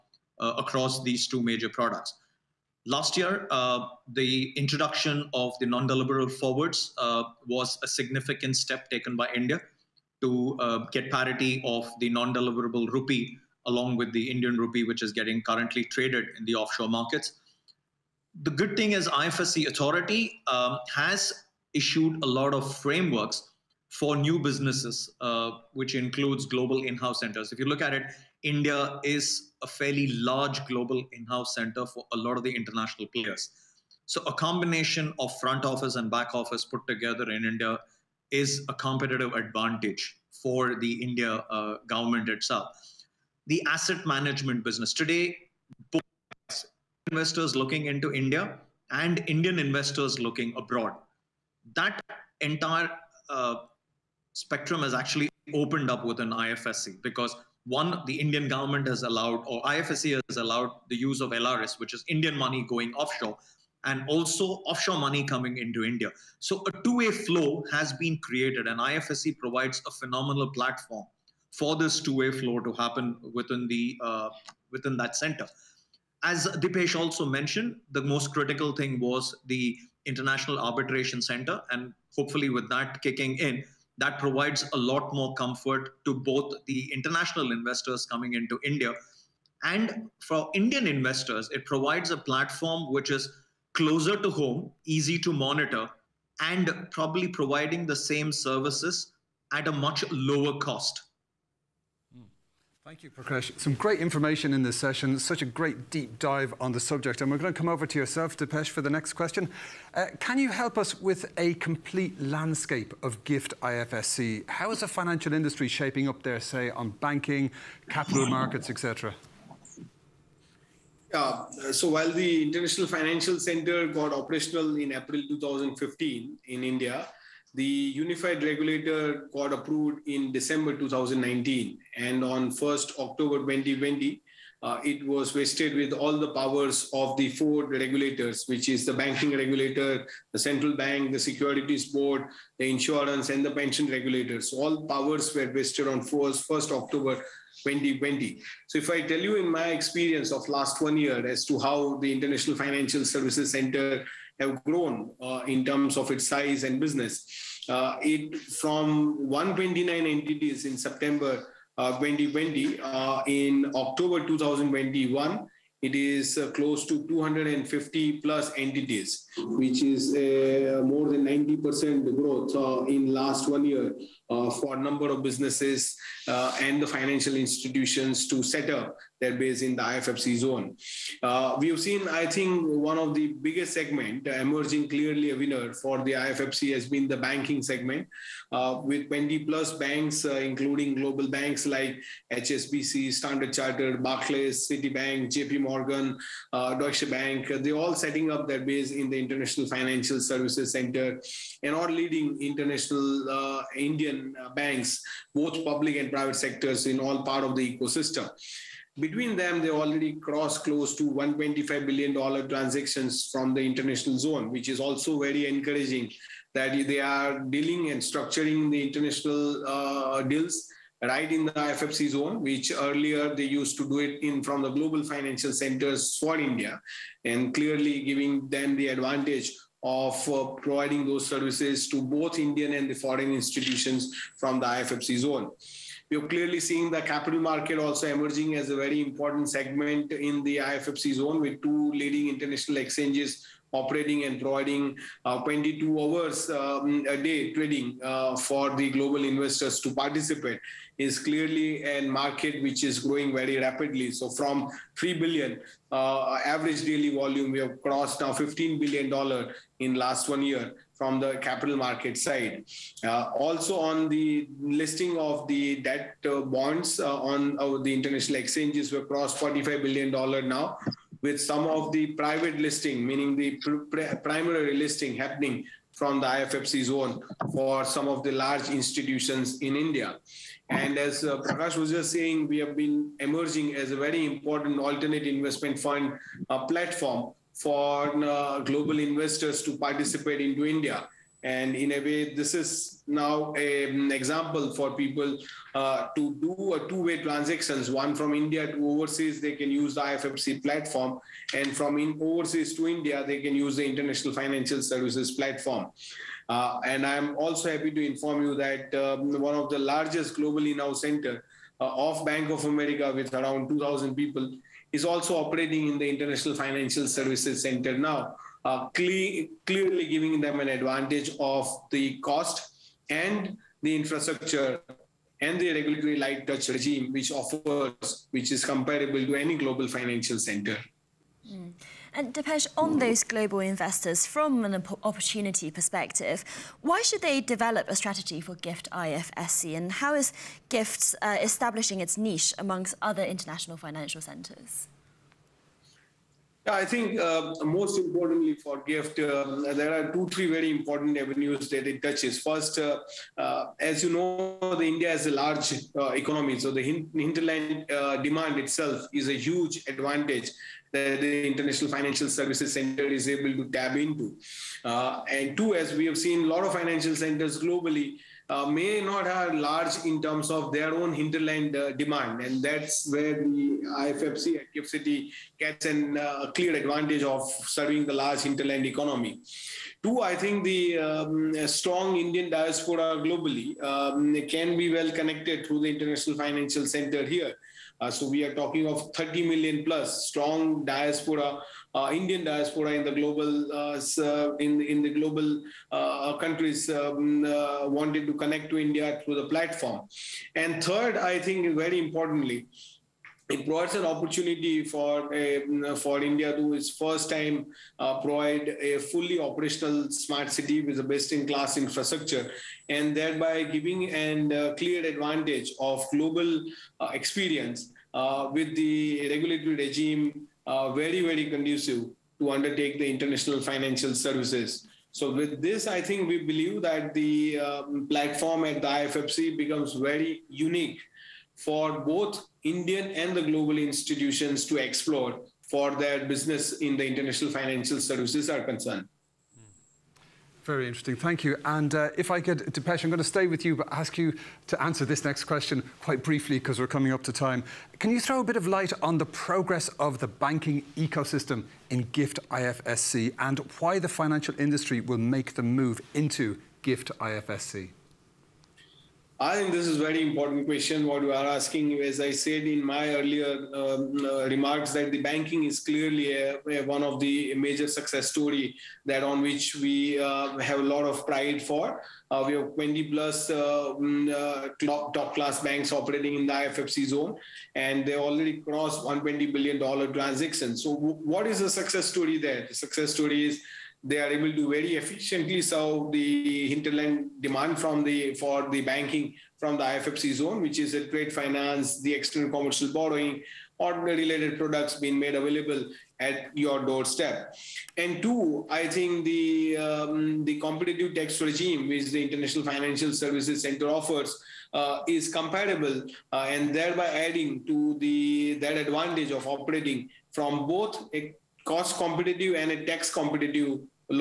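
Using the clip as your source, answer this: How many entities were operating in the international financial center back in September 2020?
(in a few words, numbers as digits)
129.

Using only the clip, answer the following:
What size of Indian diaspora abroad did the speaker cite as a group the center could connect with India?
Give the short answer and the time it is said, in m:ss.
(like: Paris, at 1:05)
30 million plus, at 6:29.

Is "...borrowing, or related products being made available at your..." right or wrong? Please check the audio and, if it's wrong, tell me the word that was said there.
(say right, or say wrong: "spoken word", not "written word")
right.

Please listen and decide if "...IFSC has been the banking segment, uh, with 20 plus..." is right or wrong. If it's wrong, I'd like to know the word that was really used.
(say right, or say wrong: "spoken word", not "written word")
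right.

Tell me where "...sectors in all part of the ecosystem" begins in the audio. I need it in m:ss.
3:26.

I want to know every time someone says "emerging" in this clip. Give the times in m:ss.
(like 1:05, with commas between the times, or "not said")
3:04, 3:58, 4:43.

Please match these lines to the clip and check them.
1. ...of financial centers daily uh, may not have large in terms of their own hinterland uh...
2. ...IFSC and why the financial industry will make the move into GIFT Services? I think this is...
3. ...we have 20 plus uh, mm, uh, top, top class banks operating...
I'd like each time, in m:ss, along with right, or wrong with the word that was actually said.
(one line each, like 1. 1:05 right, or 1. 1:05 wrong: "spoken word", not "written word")
1. 6:06 wrong: "globally", not "daily"
2. 7:32 wrong: "IFSC", not "Services"
3. 7:52 right.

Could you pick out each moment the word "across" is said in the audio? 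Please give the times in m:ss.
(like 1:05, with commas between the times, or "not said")
0:00.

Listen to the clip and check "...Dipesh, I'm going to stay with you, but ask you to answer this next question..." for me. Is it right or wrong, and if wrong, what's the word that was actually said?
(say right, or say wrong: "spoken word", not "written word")
right.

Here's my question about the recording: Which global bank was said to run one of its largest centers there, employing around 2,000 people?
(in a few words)
Bank of America.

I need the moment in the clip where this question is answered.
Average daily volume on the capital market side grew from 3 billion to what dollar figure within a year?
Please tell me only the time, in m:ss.
4:18.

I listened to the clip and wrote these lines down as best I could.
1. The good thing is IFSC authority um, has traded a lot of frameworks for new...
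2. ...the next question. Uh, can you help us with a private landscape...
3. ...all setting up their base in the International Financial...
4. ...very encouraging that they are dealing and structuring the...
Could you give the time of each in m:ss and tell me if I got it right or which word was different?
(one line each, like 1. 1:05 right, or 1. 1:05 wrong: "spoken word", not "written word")
1. 0:18 wrong: "issued", not "traded"
2. 1:48 wrong: "complete", not "private"
3. 3:17 right
4. 3:35 right.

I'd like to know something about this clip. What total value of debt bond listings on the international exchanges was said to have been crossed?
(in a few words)
$45 billion.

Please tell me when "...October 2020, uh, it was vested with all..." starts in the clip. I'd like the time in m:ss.
2:12.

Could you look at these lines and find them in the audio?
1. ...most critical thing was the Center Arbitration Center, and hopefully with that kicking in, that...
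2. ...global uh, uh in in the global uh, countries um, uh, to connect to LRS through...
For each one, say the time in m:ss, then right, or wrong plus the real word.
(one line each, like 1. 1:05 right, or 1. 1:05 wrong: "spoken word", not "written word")
1. 1:18 wrong: "International", not "Center"
2. 6:33 wrong: "India", not "LRS".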